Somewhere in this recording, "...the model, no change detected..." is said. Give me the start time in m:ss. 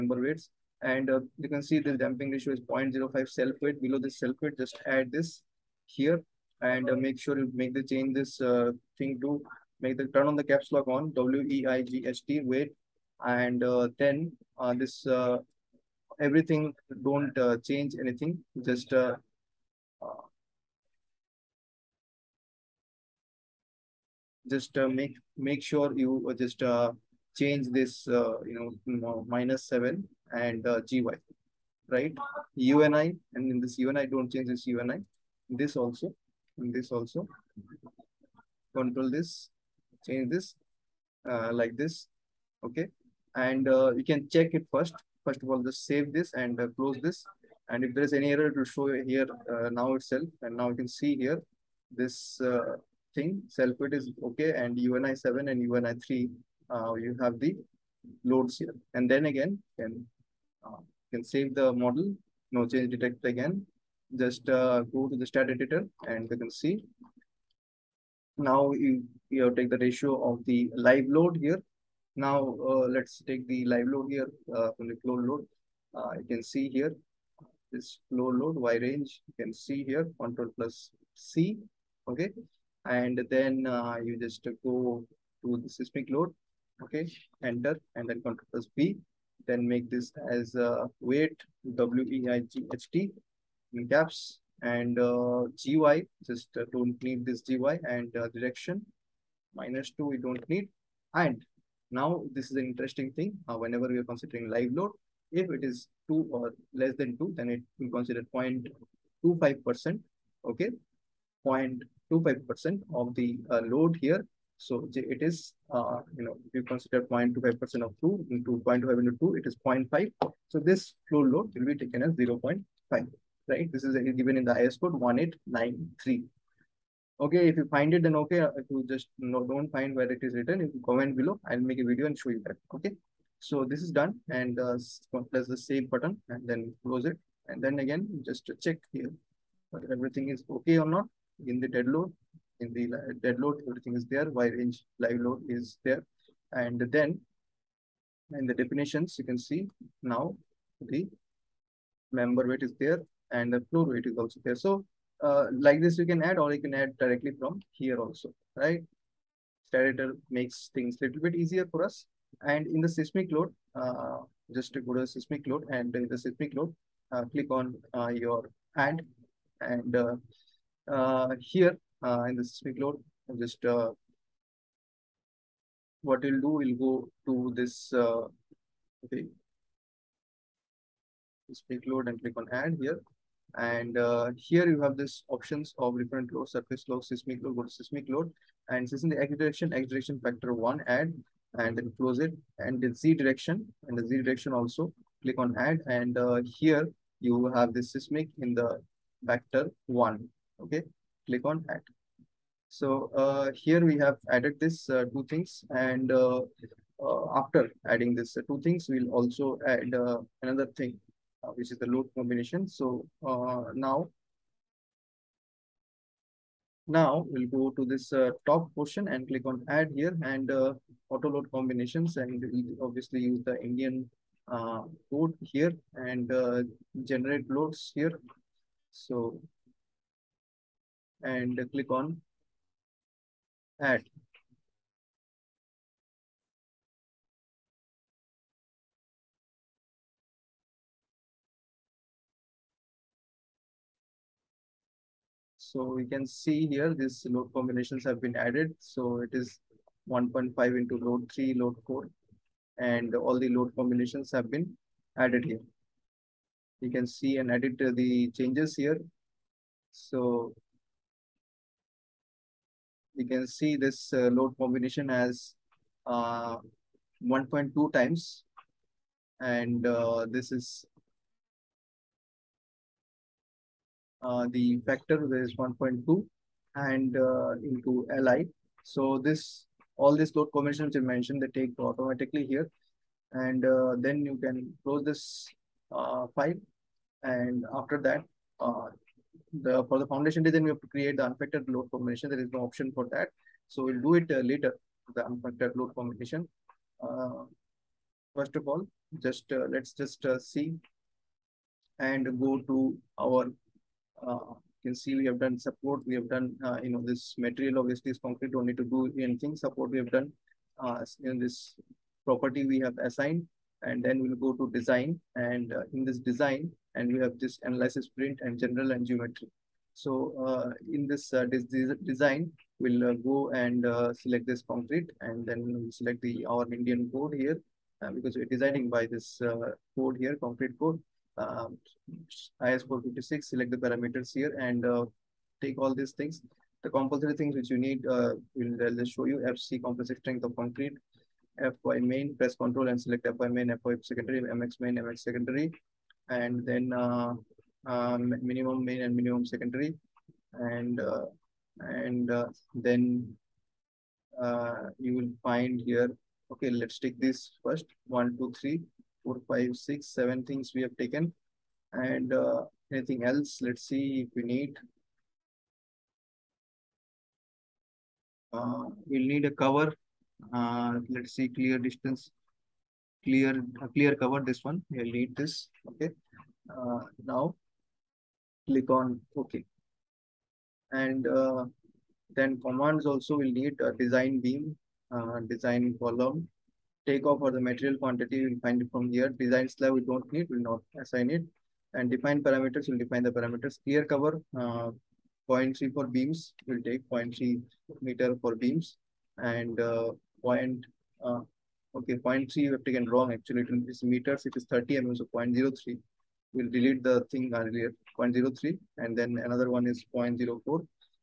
1:01.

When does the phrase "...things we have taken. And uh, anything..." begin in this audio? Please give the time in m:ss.
6:00.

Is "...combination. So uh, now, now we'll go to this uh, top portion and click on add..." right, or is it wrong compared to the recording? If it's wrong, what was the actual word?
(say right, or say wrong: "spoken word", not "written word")
right.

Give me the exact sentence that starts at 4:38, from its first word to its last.
So this all these load combinations you mentioned they take automatically here, and uh, then you can close this uh, file.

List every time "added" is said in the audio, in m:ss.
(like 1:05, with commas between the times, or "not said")
3:24, 4:08, 4:15.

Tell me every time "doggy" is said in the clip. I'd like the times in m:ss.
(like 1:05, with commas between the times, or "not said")
not said.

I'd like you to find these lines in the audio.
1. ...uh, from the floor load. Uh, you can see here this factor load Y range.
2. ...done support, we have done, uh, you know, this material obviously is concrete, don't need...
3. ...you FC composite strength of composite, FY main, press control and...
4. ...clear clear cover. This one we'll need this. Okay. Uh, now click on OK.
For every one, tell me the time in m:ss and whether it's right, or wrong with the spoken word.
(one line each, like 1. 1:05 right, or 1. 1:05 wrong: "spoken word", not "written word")
1. 1:14 wrong: "floor", not "factor"
2. 5:05 right
3. 5:39 wrong: "concrete", not "composite"
4. 6:13 right.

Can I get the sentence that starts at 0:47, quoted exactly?
And if there is any error, it will show here uh, now itself.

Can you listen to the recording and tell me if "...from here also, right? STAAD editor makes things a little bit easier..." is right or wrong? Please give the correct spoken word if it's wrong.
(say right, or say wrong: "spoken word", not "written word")
right.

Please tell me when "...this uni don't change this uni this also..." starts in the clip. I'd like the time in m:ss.
0:33.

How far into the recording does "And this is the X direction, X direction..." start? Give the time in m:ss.
3:08.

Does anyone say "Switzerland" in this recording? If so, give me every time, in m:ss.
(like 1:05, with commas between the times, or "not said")
not said.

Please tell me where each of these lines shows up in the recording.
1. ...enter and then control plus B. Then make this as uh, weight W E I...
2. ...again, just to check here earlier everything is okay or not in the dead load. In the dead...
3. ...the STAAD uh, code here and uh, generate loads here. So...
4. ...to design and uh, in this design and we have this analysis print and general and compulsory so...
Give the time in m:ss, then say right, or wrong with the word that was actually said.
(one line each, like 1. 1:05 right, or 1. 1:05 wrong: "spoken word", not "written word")
1. 1:27 right
2. 2:17 wrong: "whether", not "earlier"
3. 3:43 wrong: "Indian", not "STAAD"
4. 5:14 wrong: "geometry", not "compulsory".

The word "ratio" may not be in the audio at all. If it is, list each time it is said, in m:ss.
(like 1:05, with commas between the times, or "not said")
0:02, 1:09.